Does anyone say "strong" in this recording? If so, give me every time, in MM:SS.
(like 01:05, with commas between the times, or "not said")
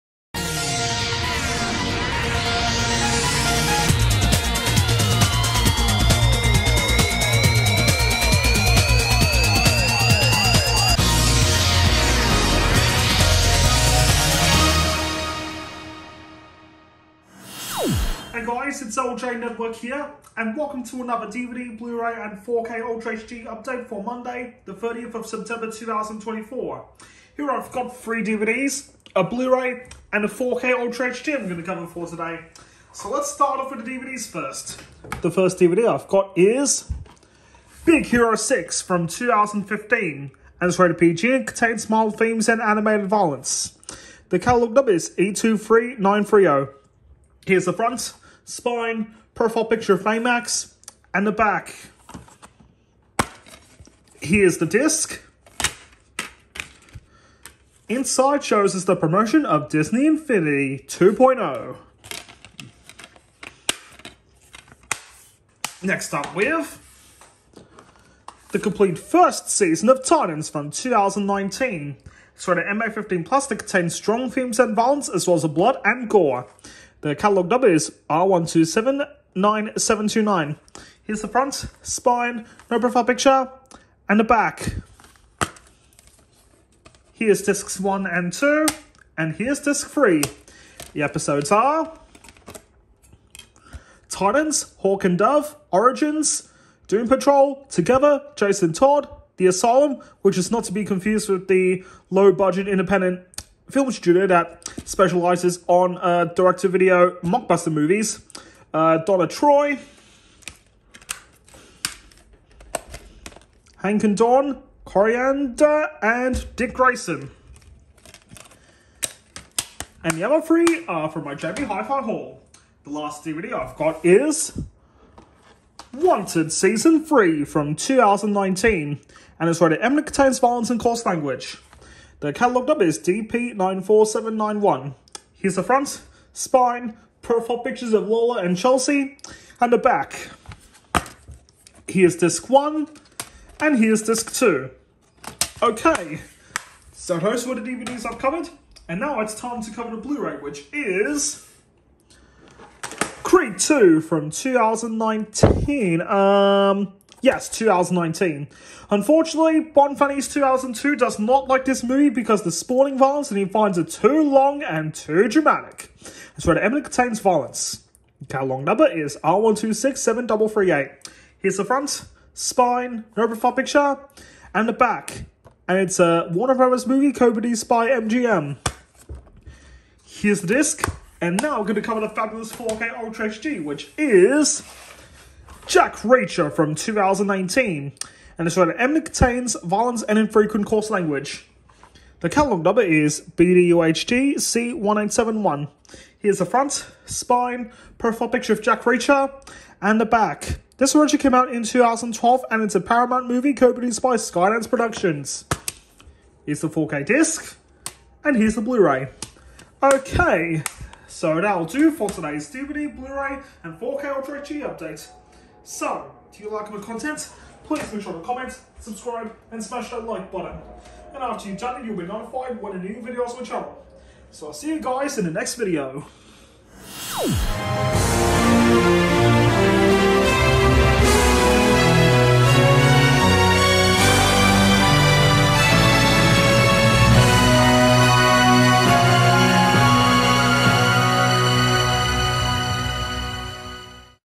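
01:13.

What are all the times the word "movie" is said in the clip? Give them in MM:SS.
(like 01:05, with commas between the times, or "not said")
01:47, 02:41, 02:56, 03:23.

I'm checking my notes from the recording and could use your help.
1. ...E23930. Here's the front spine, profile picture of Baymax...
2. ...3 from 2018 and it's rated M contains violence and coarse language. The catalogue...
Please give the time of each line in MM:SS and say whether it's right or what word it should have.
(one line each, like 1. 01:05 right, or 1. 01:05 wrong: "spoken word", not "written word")
1. 00:45 right
2. 02:07 wrong: "2019", not "2018".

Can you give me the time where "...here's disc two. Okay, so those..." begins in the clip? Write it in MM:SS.
02:23.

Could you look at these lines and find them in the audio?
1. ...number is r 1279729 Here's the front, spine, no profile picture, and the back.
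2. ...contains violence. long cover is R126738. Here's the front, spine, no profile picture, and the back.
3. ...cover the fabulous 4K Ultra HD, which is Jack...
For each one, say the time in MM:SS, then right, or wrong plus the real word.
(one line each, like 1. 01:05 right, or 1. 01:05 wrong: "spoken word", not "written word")
1. 01:17 right
2. 02:46 wrong: "number", not "cover"
3. 03:01 right.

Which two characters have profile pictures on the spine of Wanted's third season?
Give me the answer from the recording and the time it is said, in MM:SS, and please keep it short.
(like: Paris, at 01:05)
Lola and Chelsea, at 02:18.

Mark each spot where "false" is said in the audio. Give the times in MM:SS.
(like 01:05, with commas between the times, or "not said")
not said.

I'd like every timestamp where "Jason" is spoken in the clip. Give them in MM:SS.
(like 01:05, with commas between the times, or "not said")
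01:38.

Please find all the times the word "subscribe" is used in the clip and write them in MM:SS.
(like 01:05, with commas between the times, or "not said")
03:38.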